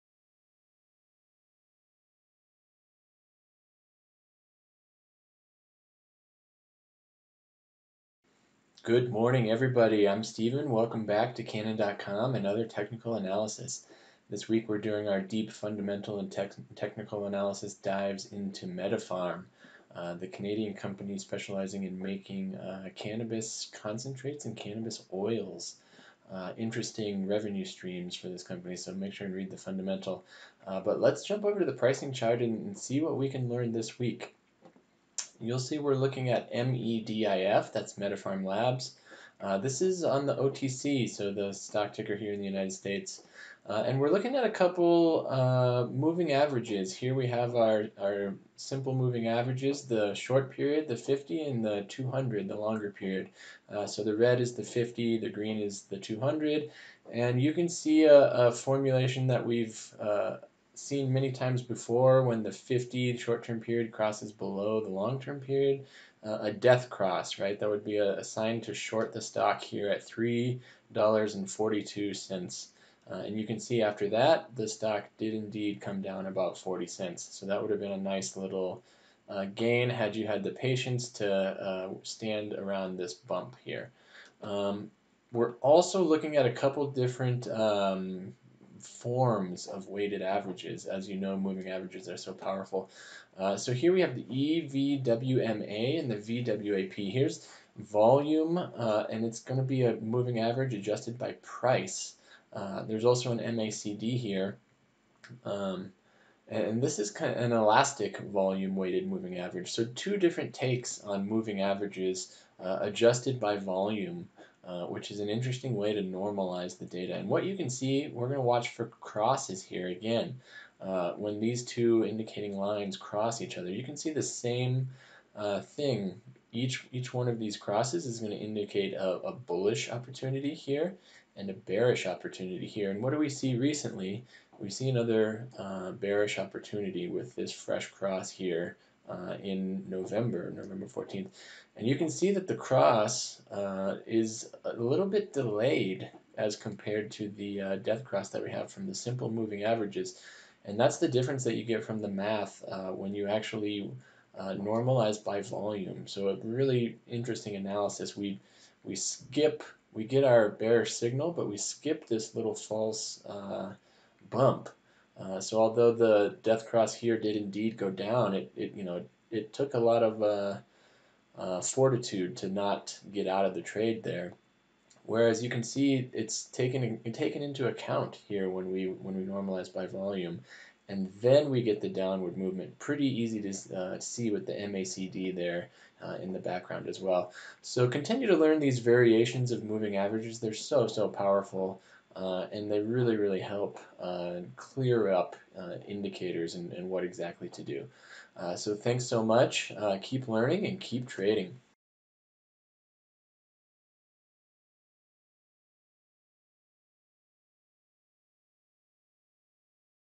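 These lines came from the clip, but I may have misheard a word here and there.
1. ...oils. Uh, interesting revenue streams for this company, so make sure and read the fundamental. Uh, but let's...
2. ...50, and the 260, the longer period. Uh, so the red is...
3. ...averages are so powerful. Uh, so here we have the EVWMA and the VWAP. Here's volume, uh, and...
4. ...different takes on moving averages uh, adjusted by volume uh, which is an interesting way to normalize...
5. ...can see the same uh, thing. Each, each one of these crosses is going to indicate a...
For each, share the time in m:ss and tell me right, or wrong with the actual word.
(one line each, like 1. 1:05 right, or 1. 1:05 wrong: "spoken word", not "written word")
1. 0:25 right
2. 0:50 wrong: "200", not "260"
3. 1:31 right
4. 1:50 right
5. 2:03 right.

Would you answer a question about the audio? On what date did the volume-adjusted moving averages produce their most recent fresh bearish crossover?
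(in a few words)
November 14th.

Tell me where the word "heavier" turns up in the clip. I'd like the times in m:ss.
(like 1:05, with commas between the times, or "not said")
not said.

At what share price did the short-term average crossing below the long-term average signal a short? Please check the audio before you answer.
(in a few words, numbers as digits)
$3.42.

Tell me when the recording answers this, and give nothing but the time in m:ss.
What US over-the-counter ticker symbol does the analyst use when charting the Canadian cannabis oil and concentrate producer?
0:36.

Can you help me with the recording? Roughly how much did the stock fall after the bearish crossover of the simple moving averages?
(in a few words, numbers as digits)
40 cents.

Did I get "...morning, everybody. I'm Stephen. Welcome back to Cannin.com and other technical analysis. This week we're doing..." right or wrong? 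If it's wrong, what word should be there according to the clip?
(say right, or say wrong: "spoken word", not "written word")
right.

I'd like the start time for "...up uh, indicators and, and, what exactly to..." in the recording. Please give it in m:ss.
3:15.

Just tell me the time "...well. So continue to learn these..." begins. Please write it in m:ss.
3:06.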